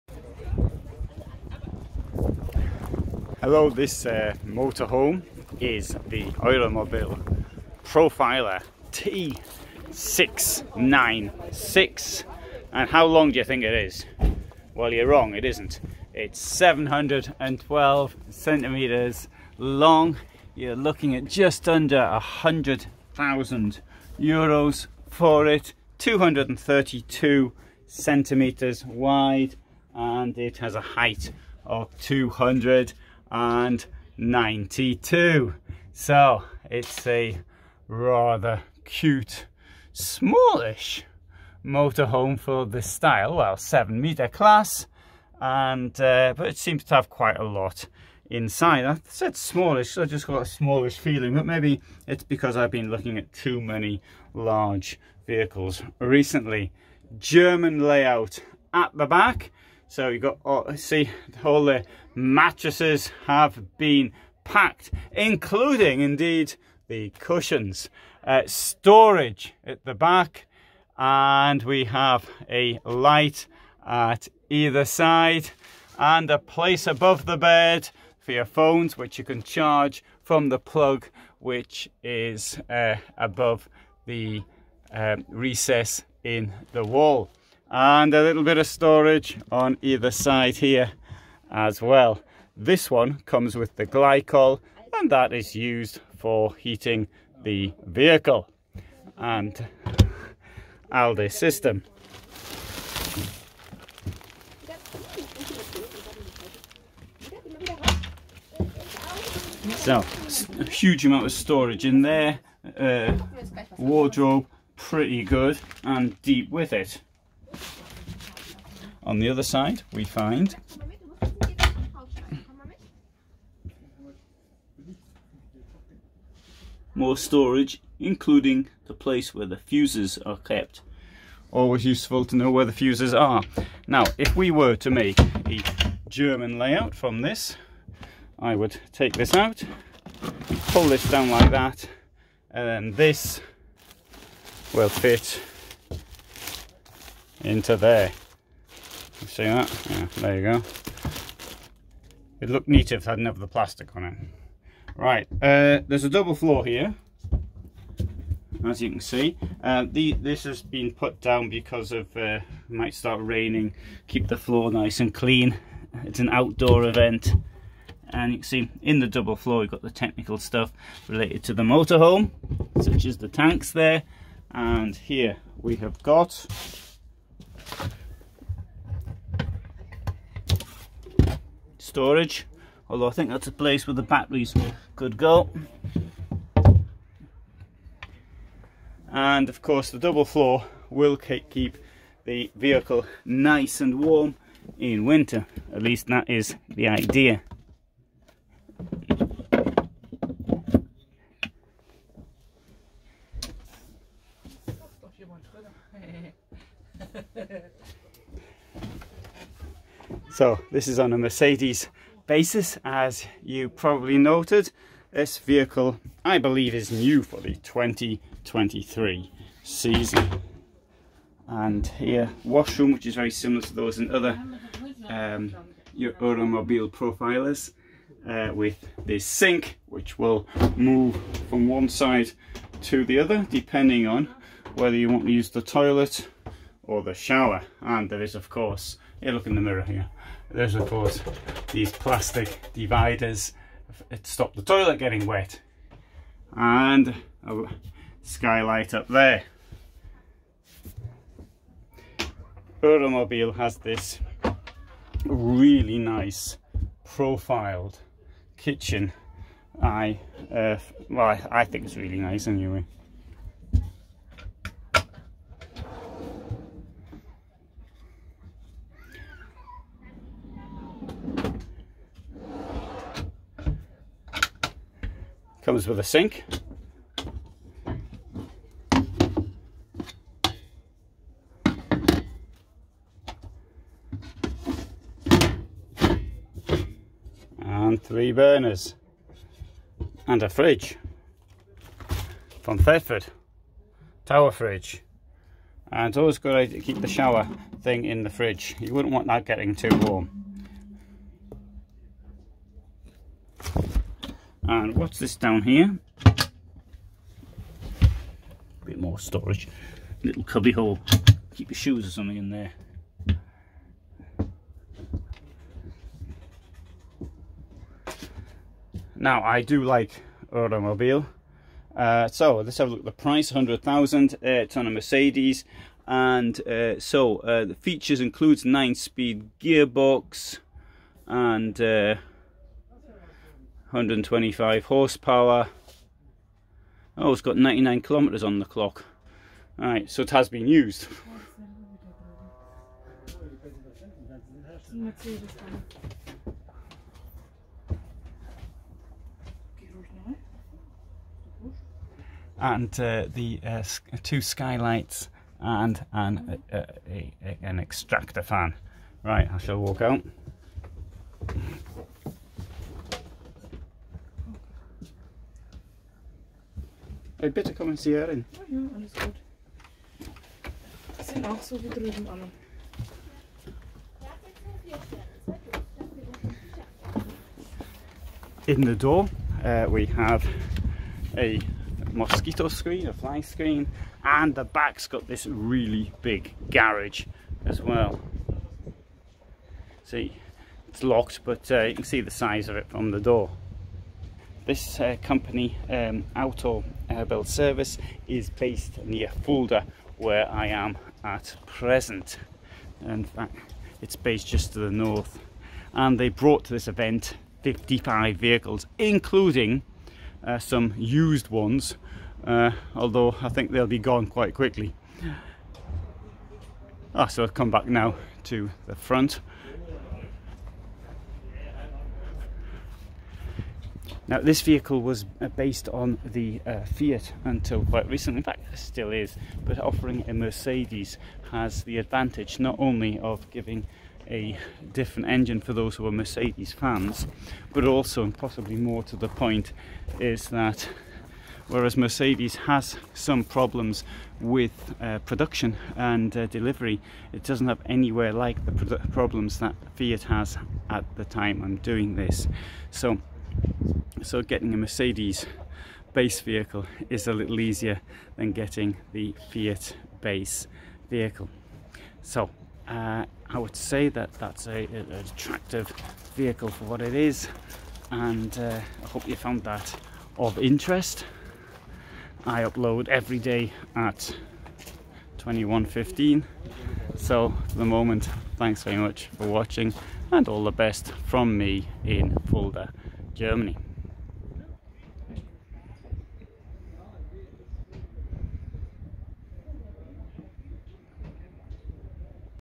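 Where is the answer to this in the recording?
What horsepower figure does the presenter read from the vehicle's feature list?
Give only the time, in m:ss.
5:33.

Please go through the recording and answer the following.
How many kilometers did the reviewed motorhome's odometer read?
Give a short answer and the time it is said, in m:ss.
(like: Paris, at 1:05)
99 kilometers, at 5:37.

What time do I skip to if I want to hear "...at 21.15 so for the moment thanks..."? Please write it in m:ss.
7:53.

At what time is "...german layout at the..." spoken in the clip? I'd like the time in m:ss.
0:57.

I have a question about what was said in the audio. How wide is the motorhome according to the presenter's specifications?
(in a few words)
232 centimeters.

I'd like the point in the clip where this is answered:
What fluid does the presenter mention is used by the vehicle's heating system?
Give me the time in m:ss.
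1:33.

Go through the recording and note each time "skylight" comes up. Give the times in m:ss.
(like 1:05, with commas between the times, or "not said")
4:08, 5:54.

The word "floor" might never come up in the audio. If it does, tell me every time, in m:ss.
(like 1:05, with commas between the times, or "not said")
2:36, 2:44, 2:49, 3:10.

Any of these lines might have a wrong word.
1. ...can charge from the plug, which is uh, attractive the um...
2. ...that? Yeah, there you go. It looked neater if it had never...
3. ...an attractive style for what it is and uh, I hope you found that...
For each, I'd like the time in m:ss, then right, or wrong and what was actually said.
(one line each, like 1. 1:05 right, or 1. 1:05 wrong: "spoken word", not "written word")
1. 1:19 wrong: "above", not "attractive"
2. 2:29 right
3. 7:44 wrong: "vehicle", not "style".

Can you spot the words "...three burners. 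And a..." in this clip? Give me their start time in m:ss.
4:48.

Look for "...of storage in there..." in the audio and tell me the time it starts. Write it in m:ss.
1:51.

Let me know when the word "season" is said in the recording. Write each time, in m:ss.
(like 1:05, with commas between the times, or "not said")
3:39.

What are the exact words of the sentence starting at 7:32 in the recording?
So so getting a Mercedes base vehicle is a little easier than getting the Fiat base vehicle.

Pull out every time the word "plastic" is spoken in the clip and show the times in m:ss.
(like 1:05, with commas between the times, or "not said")
2:33, 4:01.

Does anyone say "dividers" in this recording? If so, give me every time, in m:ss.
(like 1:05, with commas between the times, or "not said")
4:02.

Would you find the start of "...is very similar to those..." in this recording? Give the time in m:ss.
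3:43.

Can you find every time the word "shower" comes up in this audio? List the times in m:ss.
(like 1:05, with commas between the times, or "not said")
3:57, 4:57.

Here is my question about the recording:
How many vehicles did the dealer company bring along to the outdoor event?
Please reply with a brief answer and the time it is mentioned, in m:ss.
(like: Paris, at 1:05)
55, at 6:47.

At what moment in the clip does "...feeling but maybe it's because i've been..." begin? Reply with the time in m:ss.
0:50.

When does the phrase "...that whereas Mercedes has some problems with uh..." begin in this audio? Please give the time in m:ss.
7:20.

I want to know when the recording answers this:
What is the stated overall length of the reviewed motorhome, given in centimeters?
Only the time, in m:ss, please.
0:16.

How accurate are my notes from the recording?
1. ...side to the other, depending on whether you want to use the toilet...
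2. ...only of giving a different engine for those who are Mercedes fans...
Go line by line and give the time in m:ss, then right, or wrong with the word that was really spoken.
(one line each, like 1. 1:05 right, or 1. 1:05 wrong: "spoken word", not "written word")
1. 3:51 right
2. 7:12 right.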